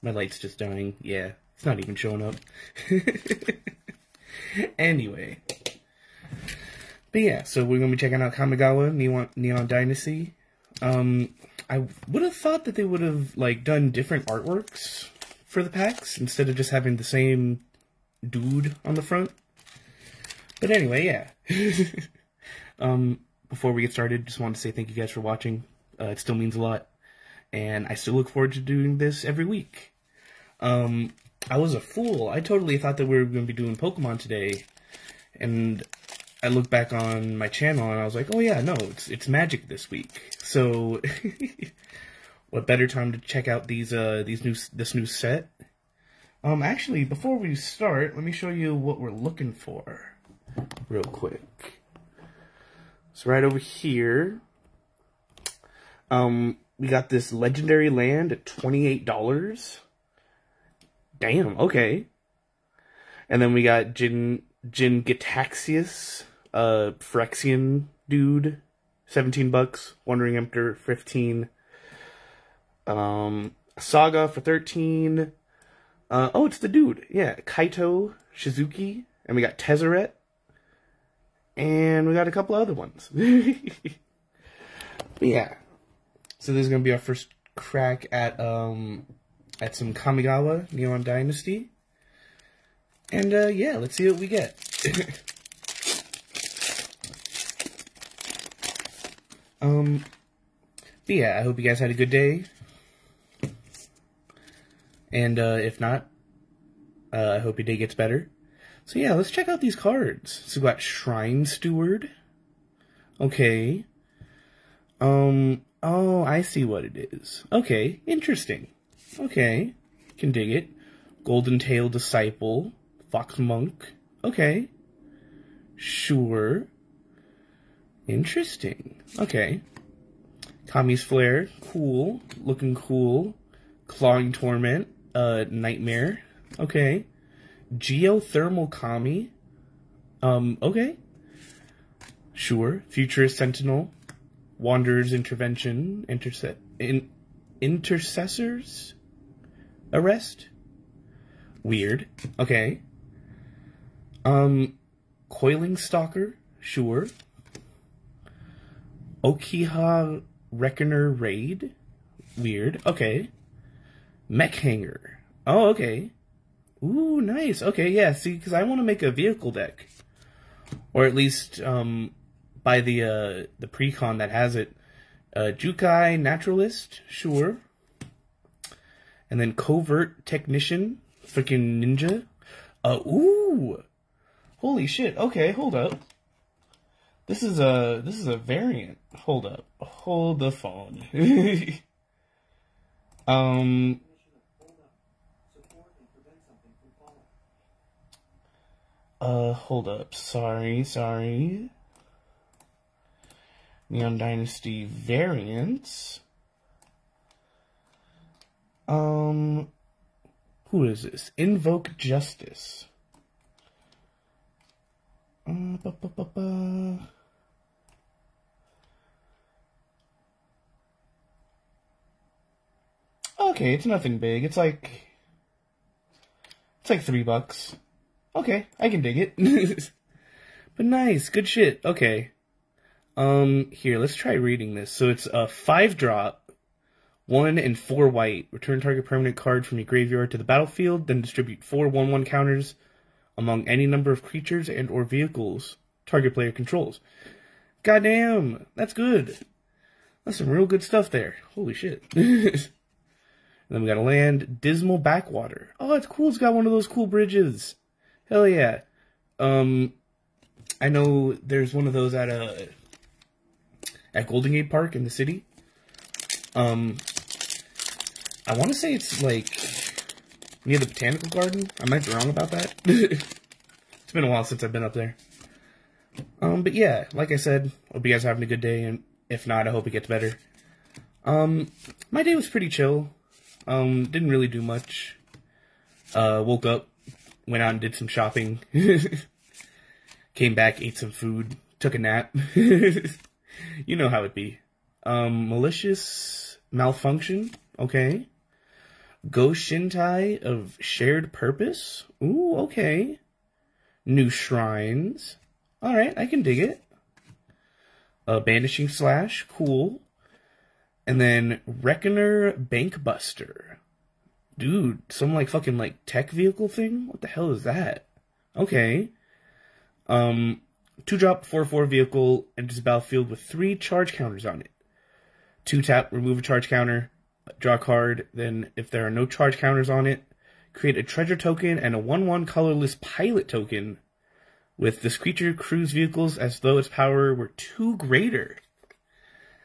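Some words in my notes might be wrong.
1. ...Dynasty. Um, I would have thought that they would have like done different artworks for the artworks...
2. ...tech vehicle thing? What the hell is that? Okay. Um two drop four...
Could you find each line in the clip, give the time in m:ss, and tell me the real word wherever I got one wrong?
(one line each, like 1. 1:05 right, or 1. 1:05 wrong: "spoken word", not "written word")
1. 0:09 wrong: "packs", not "artworks"
2. 5:16 right.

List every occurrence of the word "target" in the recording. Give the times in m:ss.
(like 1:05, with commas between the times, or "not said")
3:58, 4:06.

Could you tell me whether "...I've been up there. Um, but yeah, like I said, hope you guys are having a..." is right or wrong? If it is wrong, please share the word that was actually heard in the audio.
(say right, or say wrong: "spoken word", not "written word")
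right.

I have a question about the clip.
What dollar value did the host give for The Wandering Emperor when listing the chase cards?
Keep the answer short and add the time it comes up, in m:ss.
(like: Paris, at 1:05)
15, at 1:10.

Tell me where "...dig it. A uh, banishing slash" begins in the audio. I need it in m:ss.
5:06.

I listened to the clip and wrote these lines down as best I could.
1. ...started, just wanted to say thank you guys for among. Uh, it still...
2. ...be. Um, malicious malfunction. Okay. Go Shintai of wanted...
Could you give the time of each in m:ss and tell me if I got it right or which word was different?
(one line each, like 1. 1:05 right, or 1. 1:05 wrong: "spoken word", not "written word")
1. 0:23 wrong: "watching", not "among"
2. 4:54 wrong: "shared", not "wanted".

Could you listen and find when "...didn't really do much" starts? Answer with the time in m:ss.
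4:44.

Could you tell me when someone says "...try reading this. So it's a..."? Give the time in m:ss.
3:54.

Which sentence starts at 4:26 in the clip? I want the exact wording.
Um, I want to say it's like near the botanical garden.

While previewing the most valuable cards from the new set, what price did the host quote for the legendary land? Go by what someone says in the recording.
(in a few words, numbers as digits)
$28.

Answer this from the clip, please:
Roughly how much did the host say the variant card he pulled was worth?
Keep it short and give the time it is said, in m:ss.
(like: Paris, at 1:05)
3 bucks, at 3:47.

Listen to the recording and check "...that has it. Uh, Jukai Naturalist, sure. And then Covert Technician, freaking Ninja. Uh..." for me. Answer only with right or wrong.
right.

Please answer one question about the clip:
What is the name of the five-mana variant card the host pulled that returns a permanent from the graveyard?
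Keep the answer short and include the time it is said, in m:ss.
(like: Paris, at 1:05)
Invoke Justice, at 3:31.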